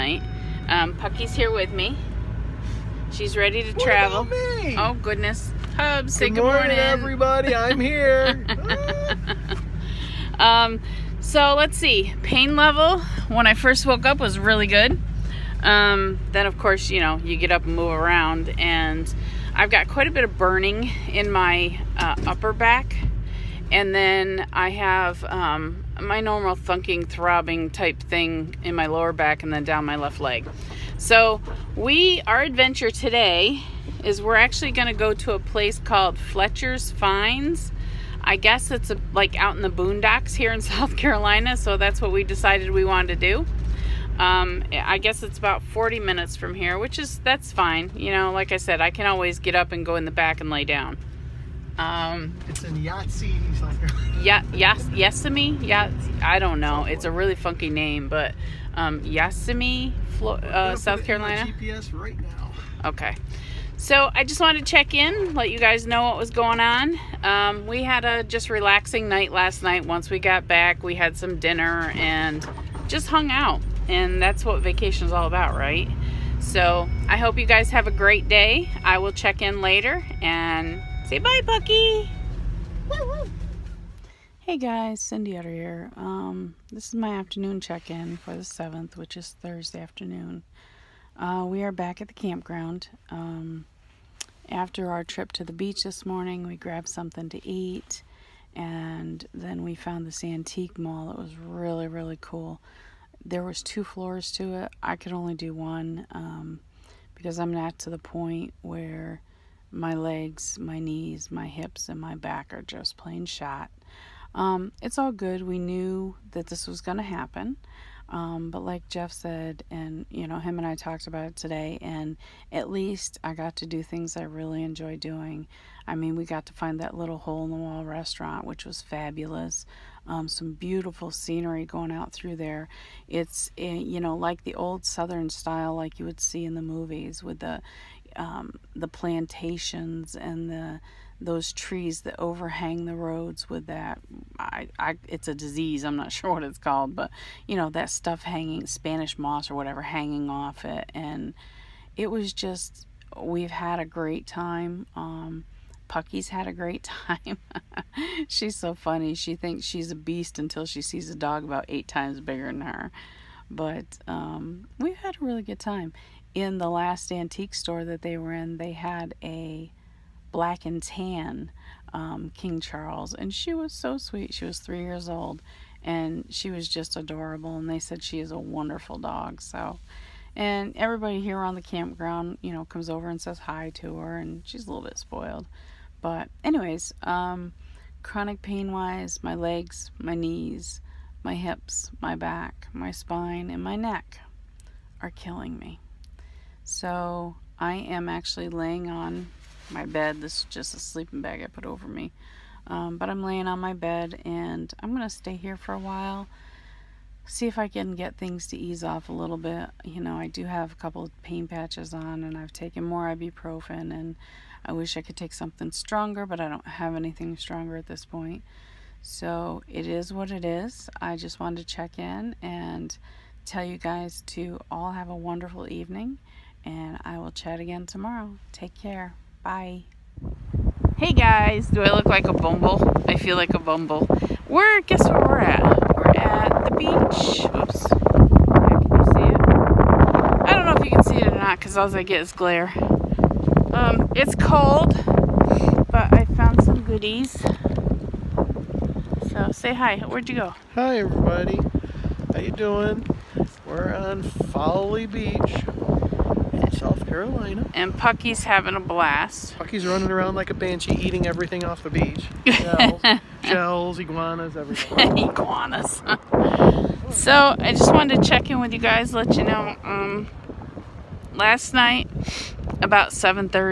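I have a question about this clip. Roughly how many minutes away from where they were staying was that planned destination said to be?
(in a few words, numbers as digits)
40.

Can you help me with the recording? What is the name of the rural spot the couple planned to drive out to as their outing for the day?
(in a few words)
Fletcher's Finds.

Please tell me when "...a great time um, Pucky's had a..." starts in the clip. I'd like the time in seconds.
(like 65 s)
153 s.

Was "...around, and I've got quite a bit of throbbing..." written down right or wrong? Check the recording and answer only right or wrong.
wrong.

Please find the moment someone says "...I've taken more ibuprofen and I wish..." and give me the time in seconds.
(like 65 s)
212 s.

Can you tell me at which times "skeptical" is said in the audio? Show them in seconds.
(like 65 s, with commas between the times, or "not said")
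not said.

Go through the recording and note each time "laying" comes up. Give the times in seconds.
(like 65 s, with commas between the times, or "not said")
198 s, 203 s.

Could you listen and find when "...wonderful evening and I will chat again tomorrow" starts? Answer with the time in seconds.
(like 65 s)
225 s.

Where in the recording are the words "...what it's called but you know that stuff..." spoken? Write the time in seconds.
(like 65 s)
146 s.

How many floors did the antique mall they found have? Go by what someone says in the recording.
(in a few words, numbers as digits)
2.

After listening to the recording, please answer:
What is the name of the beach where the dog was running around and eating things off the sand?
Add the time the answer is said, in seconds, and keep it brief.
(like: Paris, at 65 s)
Folly Beach, at 254 s.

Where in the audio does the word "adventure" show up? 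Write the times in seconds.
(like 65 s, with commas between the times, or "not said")
32 s.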